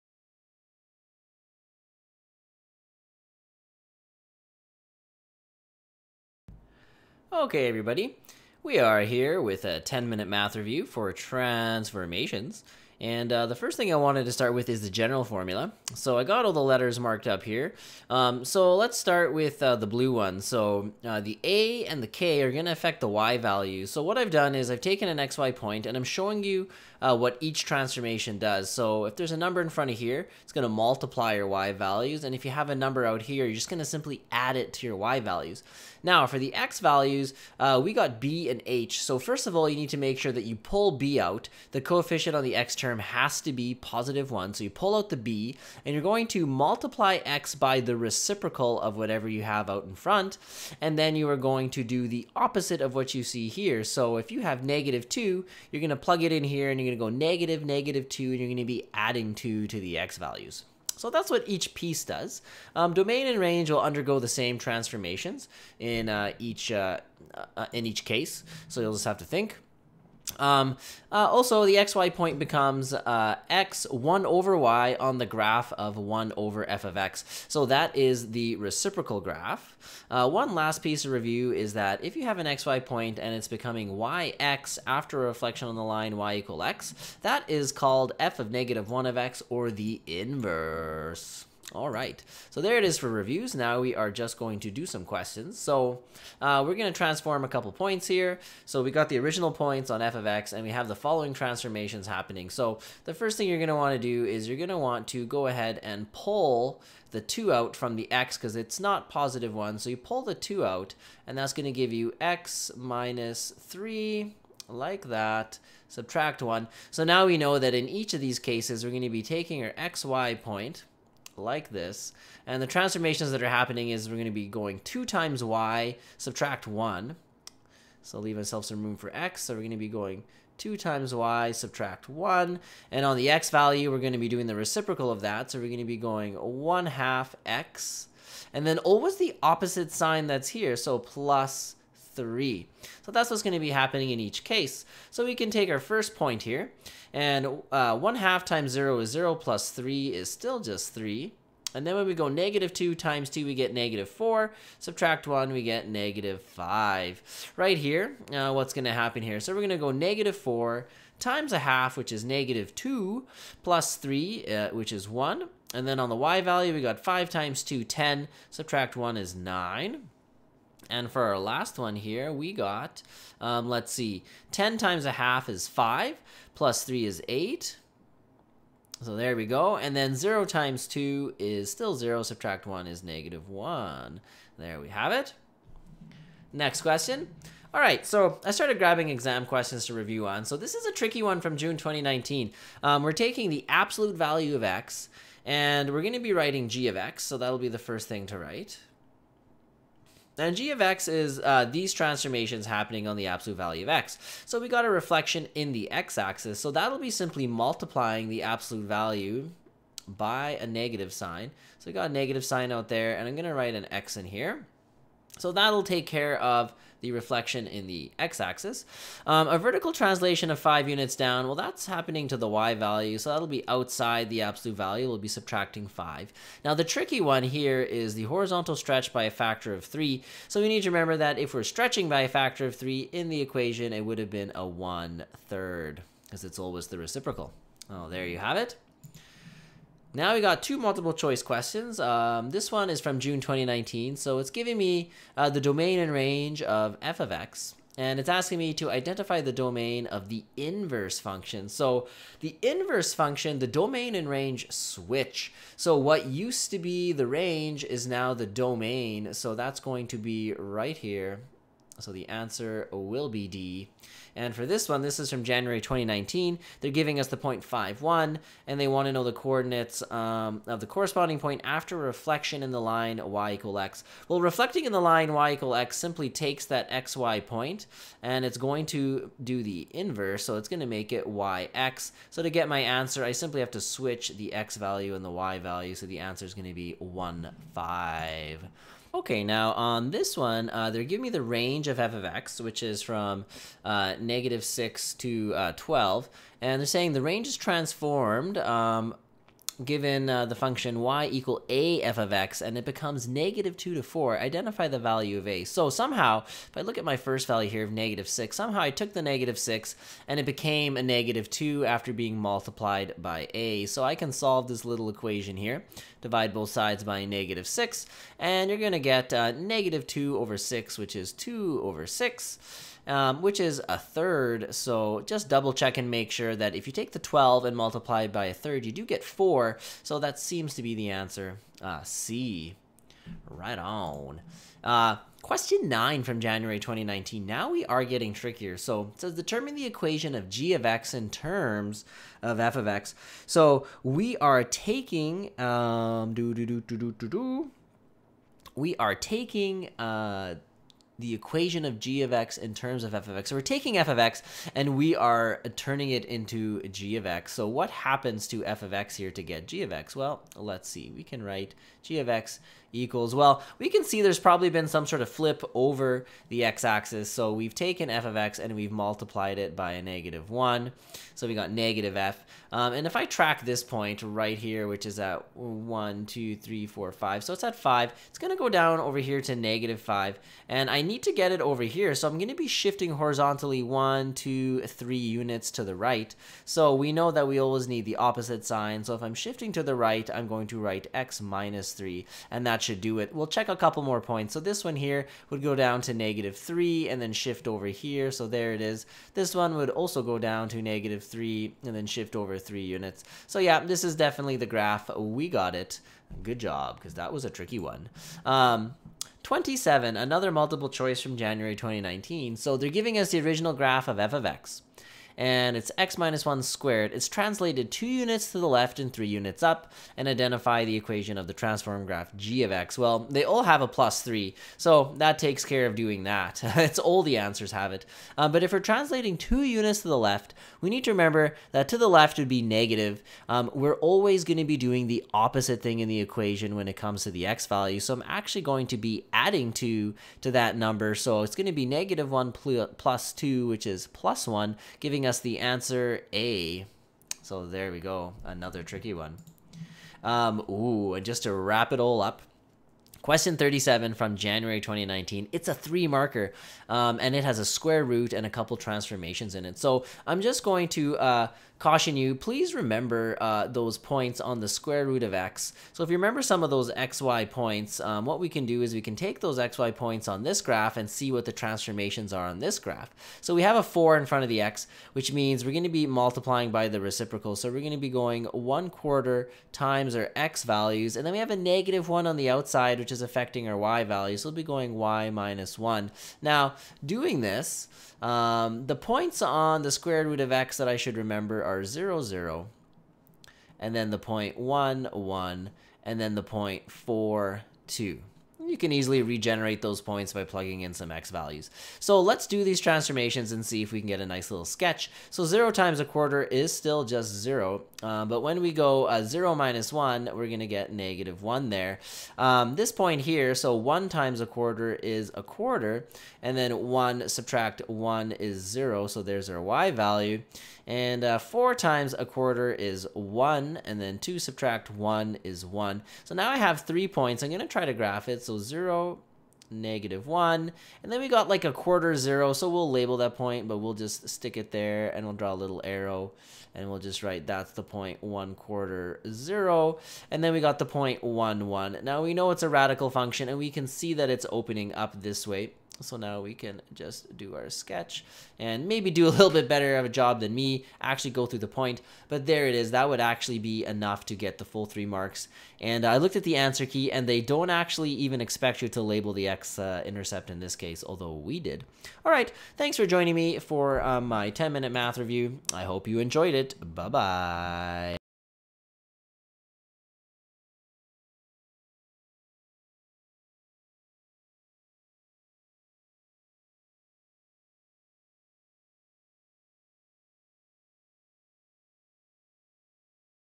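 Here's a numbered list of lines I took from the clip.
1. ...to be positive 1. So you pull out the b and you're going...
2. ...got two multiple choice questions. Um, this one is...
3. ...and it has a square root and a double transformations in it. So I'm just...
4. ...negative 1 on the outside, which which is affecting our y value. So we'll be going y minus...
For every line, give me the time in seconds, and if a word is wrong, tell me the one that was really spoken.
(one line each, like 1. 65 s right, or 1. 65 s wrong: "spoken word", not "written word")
1. 43 s right
2. 240 s right
3. 457 s wrong: "couple", not "double"
4. 481 s right.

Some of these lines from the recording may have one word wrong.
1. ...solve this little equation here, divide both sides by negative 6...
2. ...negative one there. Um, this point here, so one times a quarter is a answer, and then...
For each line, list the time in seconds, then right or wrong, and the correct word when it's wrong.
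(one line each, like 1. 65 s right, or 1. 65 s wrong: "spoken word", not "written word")
1. 314 s right
2. 510 s wrong: "quarter", not "answer".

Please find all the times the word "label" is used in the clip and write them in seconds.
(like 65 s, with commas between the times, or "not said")
532 s, 559 s.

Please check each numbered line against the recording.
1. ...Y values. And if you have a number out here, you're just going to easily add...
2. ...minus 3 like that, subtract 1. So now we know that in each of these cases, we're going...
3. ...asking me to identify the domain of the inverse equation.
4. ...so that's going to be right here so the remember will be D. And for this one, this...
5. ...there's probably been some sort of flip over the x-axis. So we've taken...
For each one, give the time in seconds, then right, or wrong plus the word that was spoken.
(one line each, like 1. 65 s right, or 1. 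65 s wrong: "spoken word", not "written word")
1. 31 s wrong: "simply", not "easily"
2. 112 s right
3. 248 s wrong: "function", not "equation"
4. 259 s wrong: "answer", not "remember"
5. 364 s right.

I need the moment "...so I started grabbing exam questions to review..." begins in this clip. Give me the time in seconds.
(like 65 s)
188 s.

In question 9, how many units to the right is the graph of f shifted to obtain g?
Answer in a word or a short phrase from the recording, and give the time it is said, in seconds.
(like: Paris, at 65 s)
3, at 384 s.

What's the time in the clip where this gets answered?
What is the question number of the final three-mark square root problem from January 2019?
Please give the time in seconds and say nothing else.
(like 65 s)
453 s.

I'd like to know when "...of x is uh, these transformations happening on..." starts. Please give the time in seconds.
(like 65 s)
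200 s.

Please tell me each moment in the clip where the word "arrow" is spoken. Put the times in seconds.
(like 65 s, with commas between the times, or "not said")
535 s.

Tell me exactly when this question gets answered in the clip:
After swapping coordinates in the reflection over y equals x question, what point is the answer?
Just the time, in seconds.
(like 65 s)
286 s.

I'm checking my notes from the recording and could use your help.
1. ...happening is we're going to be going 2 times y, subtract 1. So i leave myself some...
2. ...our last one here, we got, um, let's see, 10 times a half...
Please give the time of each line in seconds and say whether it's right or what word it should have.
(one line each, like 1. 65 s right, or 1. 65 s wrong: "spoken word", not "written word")
1. 123 s right
2. 171 s right.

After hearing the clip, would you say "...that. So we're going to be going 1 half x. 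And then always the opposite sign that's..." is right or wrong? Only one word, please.
right.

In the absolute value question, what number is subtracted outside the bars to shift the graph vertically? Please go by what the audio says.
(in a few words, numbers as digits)
5.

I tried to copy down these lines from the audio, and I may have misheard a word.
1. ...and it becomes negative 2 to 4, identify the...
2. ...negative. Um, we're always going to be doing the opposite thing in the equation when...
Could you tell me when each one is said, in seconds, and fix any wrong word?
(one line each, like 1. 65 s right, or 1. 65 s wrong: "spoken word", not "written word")
1. 302 s right
2. 432 s right.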